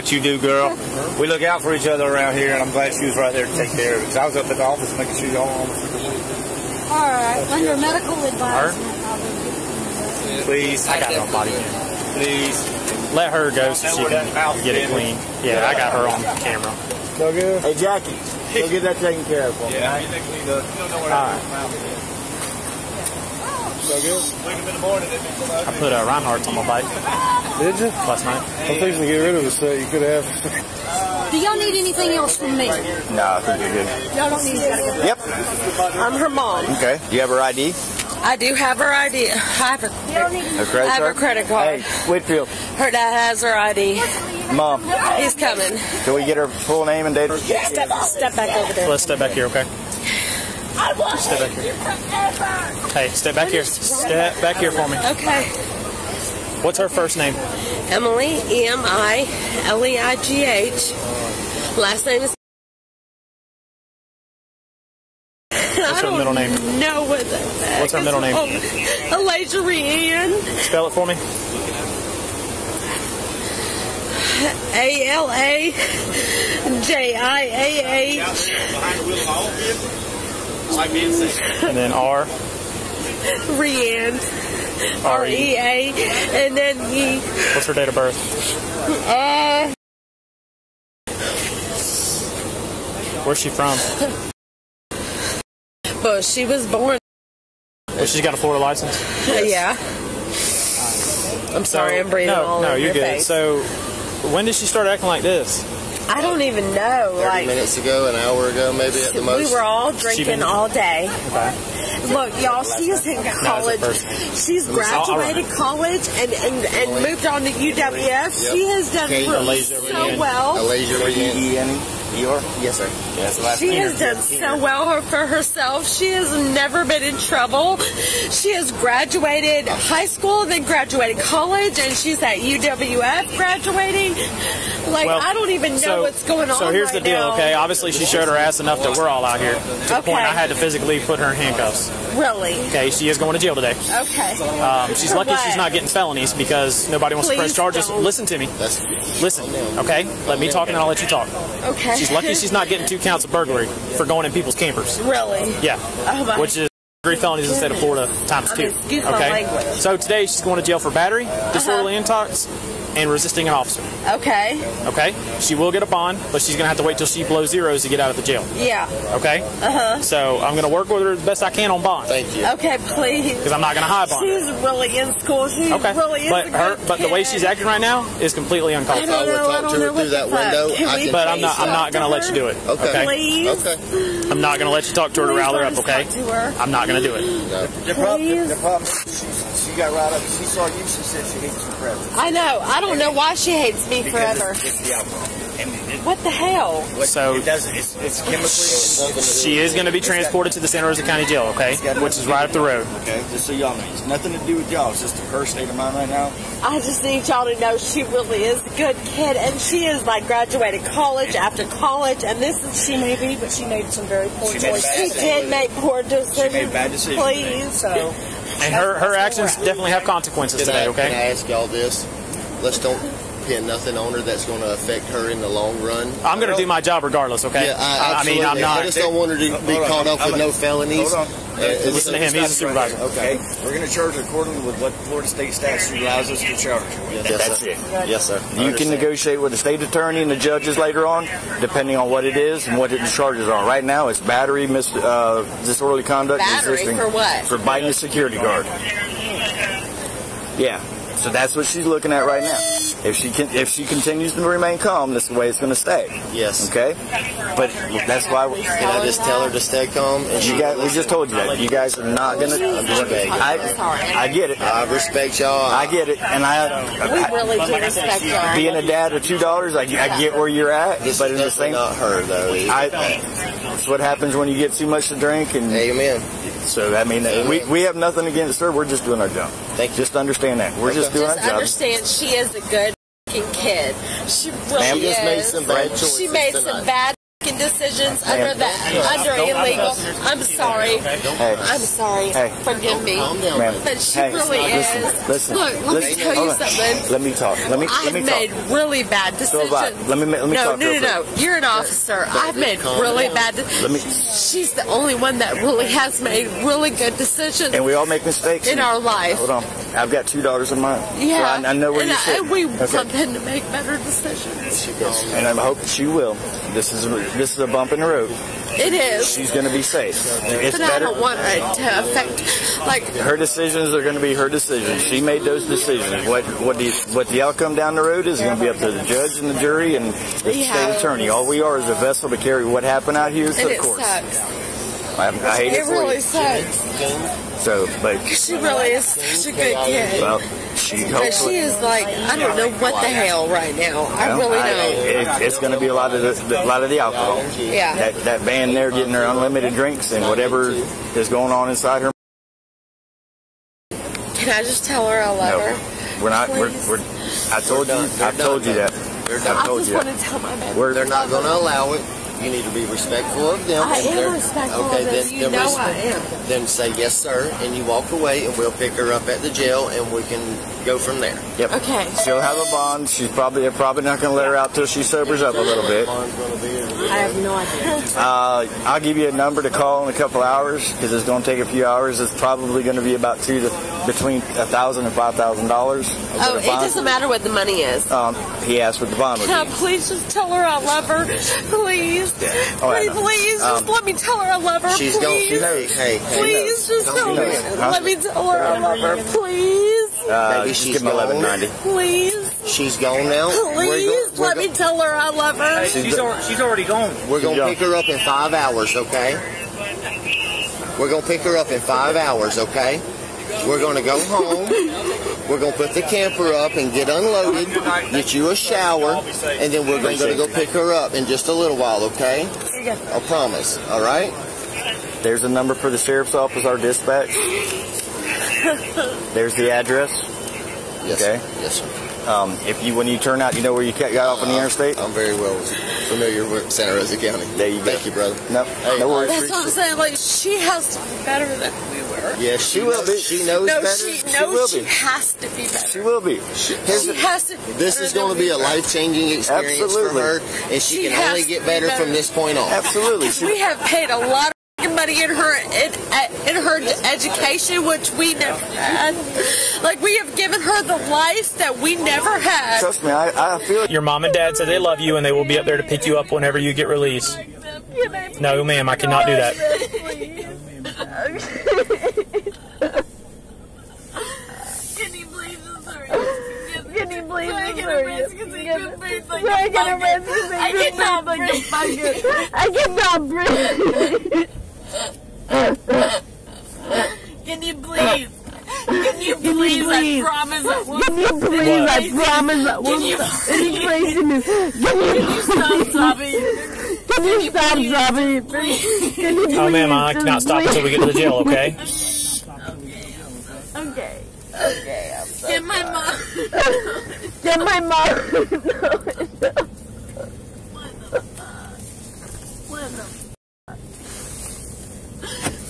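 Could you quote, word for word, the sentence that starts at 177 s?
the way she's acting right now is completely uncalled for.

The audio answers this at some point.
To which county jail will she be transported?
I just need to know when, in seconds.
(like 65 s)
200 s.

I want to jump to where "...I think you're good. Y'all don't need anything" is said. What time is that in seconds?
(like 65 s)
32 s.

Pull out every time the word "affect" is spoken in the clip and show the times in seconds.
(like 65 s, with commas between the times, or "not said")
224 s, 322 s.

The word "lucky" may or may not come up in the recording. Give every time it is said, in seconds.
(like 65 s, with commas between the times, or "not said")
145 s, 152 s.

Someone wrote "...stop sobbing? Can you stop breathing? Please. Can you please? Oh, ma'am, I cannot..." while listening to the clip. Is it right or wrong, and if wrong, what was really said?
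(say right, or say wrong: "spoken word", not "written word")
wrong: "sobbing", not "breathing".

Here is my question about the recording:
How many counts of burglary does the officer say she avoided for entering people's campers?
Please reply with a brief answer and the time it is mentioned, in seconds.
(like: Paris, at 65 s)
2, at 152 s.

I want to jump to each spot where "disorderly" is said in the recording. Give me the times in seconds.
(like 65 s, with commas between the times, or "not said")
161 s, 245 s.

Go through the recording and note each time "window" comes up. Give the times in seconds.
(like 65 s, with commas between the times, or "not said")
180 s.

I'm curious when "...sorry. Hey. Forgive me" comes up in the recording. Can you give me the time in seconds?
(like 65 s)
291 s.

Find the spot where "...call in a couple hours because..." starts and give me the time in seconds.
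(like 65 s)
379 s.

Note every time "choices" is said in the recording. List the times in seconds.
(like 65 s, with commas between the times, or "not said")
214 s, 285 s.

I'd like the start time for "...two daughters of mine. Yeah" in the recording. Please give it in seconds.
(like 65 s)
310 s.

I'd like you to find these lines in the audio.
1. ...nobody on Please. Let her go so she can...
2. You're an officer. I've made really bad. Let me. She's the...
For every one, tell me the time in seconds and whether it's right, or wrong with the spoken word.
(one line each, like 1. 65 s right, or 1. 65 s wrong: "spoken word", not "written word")
1. 11 s right
2. 301 s right.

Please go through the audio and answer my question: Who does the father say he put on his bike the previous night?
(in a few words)
Reinhardt.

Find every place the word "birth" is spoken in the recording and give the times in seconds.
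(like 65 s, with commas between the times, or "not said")
47 s, 87 s.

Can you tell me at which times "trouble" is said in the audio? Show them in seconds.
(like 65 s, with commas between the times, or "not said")
127 s.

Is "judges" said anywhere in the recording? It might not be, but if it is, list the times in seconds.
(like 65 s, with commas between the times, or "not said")
240 s, 329 s.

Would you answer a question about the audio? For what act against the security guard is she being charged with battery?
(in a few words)
Biting.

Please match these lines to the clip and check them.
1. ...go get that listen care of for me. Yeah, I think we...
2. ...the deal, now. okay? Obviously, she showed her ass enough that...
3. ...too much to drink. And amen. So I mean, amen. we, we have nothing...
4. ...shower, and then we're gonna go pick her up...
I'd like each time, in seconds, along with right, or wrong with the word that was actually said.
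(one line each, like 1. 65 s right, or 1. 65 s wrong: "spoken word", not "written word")
1. 18 s wrong: "taken", not "listen"
2. 136 s right
3. 274 s right
4. 418 s right.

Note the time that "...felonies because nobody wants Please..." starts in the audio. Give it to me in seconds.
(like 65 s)
145 s.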